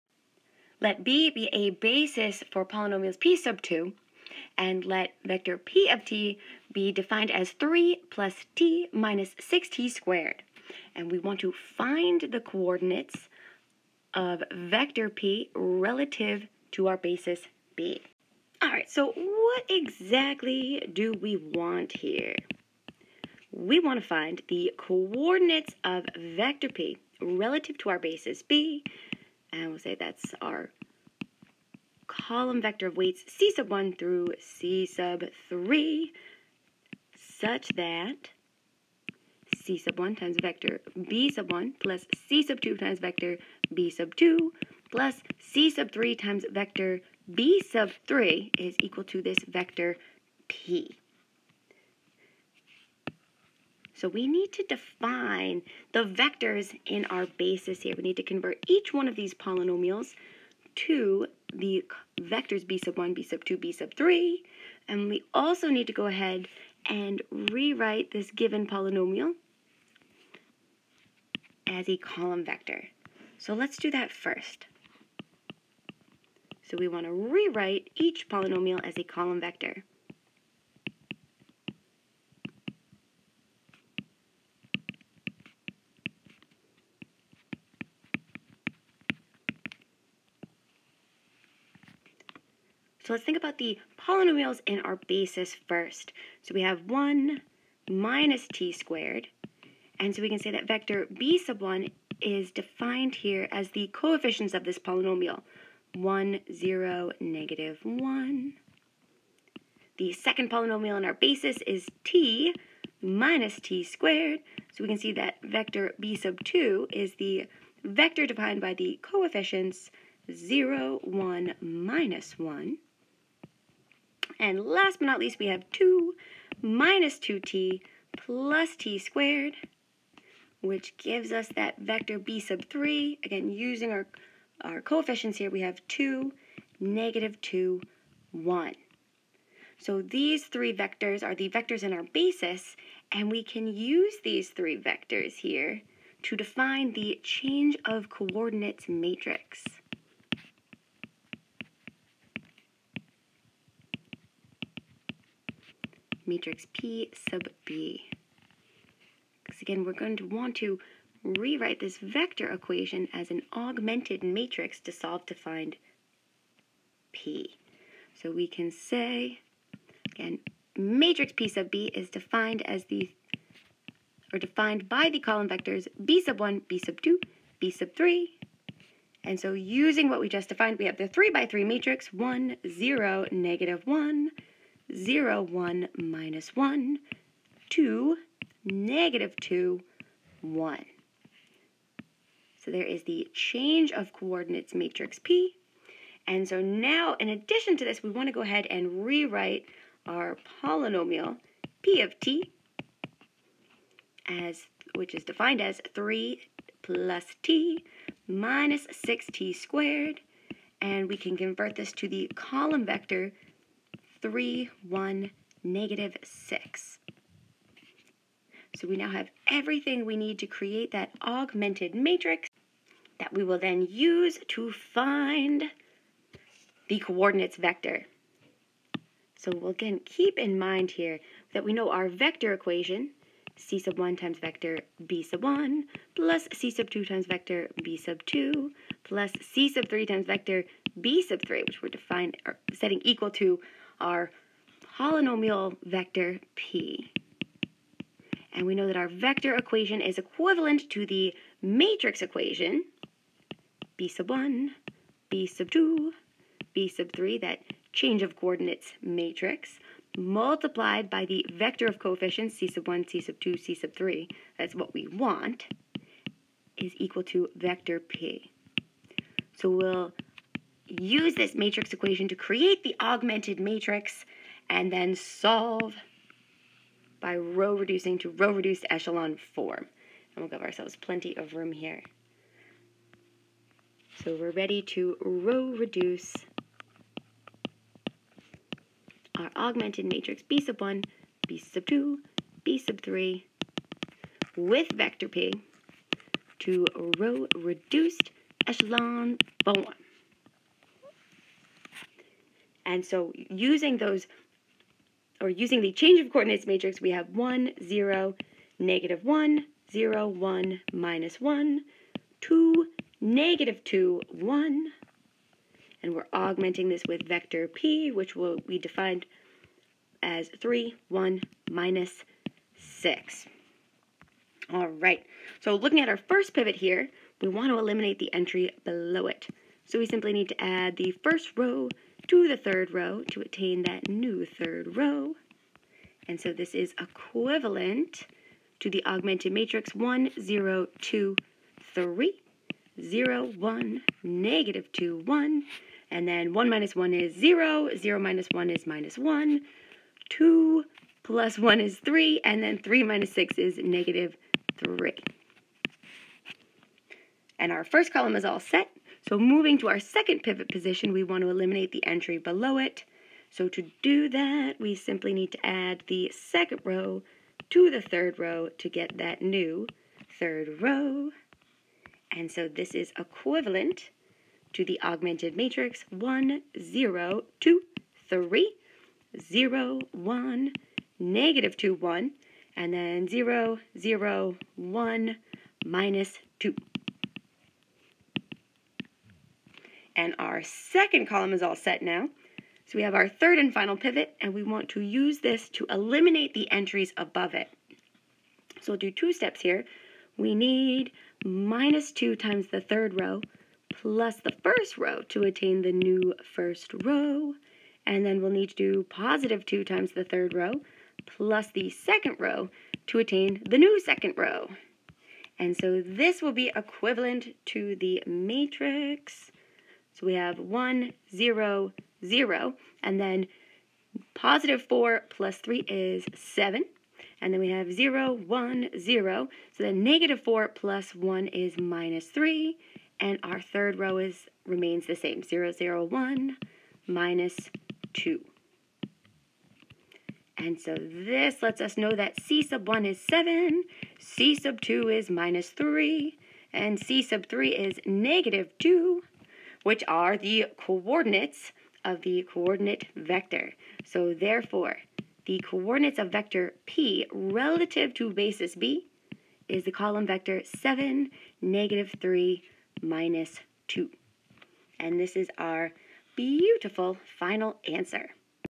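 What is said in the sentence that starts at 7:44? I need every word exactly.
And this is our beautiful final answer.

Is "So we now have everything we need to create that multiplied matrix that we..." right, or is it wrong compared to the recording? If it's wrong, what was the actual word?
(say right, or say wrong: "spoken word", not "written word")
wrong: "augmented", not "multiplied".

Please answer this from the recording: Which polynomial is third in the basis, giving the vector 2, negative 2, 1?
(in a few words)
2 minus 2t plus t squared.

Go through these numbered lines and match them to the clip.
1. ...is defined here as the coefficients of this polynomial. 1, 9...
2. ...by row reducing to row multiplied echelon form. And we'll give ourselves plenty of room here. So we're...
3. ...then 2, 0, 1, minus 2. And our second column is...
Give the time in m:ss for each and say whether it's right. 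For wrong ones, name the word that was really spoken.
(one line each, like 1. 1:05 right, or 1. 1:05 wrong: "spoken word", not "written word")
1. 1:42 wrong: "0", not "9"
2. 4:37 wrong: "reduced", not "multiplied"
3. 6:22 wrong: "0", not "2".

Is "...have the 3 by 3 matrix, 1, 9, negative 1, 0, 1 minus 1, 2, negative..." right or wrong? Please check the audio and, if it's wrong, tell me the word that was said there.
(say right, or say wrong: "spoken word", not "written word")
wrong: "0", not "9".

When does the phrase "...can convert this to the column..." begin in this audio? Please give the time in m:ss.
3:31.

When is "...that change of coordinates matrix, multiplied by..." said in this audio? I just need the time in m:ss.
4:17.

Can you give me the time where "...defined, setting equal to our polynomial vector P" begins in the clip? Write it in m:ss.
4:01.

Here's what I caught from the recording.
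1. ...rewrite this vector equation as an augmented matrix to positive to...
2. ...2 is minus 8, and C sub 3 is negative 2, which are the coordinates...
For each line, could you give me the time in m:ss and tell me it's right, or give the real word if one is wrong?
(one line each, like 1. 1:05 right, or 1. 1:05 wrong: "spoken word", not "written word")
1. 2:41 wrong: "solve", not "positive"
2. 7:24 wrong: "3", not "8".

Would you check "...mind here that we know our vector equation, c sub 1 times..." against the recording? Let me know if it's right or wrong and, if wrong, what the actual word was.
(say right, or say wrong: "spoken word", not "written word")
right.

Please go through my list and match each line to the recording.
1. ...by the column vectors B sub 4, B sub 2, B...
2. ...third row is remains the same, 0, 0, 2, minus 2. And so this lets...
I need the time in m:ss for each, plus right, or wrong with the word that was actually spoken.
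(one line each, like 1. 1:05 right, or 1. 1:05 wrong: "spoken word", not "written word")
1. 2:54 wrong: "1", not "4"
2. 7:13 wrong: "1", not "2".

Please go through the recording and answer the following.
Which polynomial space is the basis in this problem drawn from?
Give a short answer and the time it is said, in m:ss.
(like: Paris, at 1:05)
P sub 2, at 0:03.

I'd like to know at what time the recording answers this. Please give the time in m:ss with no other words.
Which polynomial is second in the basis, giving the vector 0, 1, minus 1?
1:52.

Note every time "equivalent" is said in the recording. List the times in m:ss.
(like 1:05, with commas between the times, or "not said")
4:10, 5:36, 6:13, 6:56.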